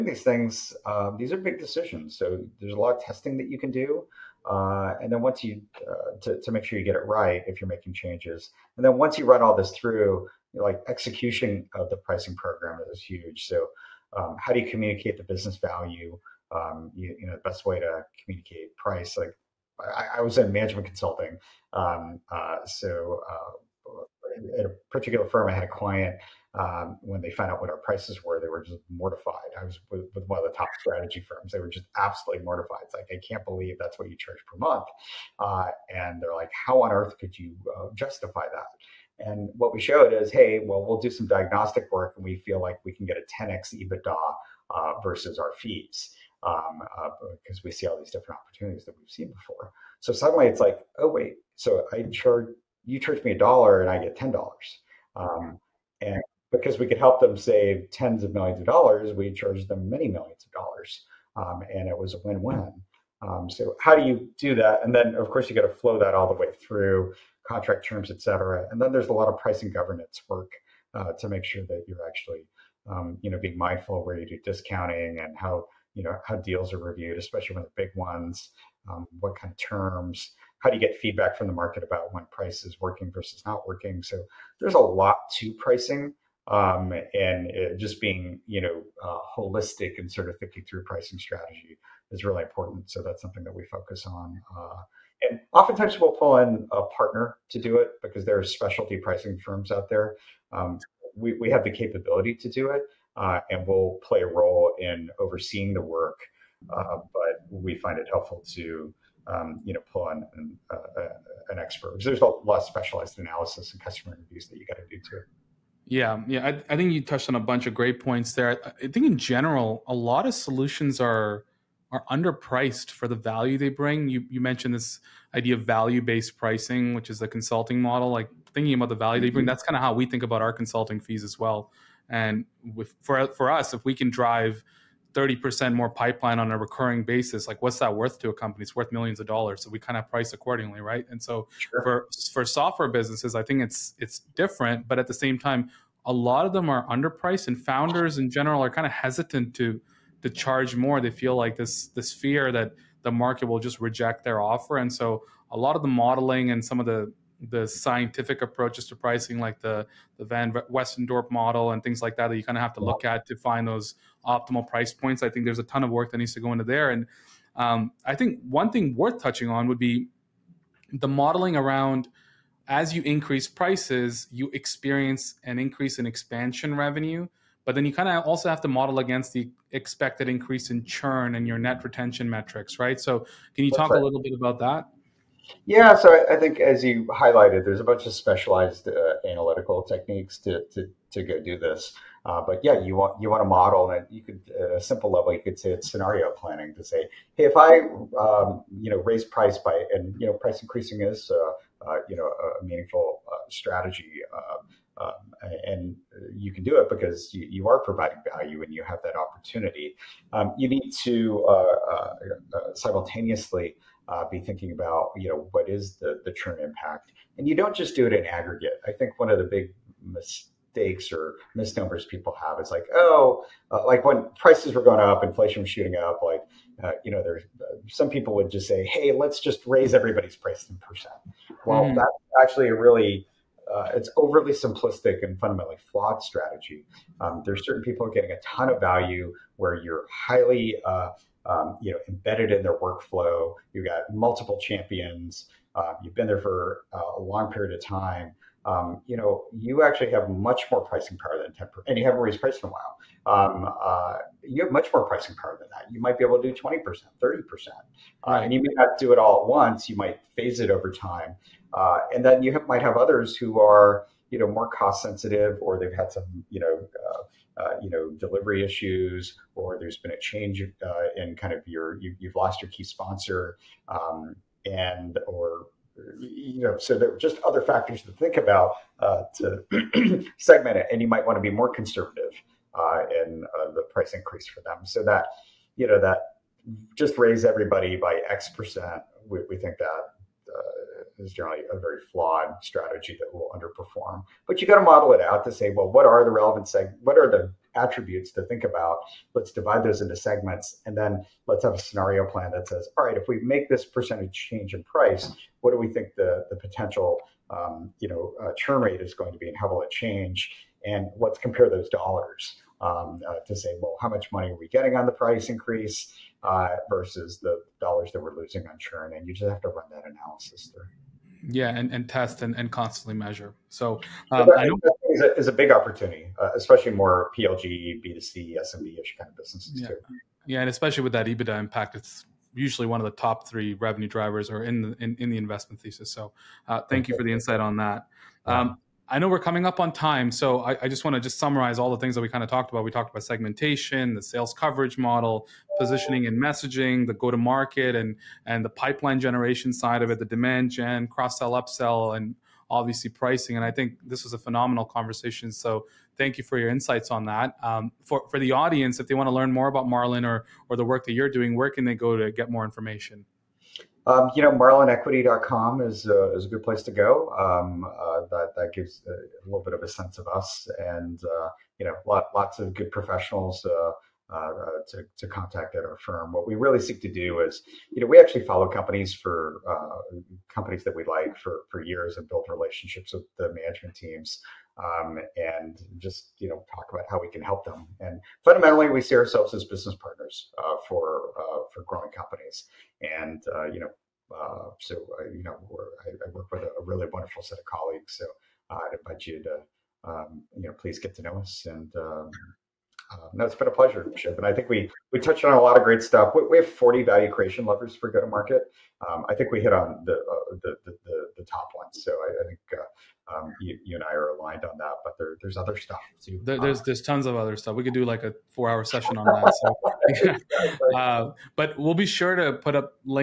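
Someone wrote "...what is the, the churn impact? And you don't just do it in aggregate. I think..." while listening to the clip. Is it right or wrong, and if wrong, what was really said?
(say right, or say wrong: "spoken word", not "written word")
right.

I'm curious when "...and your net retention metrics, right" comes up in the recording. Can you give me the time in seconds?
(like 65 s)
181 s.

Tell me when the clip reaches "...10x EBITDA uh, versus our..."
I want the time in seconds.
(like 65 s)
43 s.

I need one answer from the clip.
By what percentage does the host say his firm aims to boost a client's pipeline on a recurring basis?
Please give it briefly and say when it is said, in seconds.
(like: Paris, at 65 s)
30%, at 135 s.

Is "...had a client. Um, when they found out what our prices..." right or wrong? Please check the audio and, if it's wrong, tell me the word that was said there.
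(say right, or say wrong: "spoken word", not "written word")
right.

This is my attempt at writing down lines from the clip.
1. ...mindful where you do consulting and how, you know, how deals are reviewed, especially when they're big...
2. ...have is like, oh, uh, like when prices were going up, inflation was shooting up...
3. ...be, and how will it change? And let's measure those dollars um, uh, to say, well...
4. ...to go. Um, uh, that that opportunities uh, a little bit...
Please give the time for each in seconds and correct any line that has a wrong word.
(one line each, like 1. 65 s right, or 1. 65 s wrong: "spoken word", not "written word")
1. 73 s wrong: "discounting", not "consulting"
2. 222 s right
3. 309 s wrong: "compare", not "measure"
4. 366 s wrong: "gives", not "opportunities".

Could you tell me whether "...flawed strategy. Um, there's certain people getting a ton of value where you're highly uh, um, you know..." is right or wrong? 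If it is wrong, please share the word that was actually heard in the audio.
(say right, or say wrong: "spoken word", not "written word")
right.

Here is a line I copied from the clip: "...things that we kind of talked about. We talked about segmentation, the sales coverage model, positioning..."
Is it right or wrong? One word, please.
right.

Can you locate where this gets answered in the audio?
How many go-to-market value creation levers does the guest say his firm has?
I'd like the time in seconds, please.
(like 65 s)
406 s.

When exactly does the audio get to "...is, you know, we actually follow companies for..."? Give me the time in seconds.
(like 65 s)
377 s.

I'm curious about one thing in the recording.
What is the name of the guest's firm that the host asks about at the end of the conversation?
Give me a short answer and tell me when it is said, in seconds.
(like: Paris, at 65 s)
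Marlin, at 359 s.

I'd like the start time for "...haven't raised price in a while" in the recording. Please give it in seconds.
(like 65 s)
252 s.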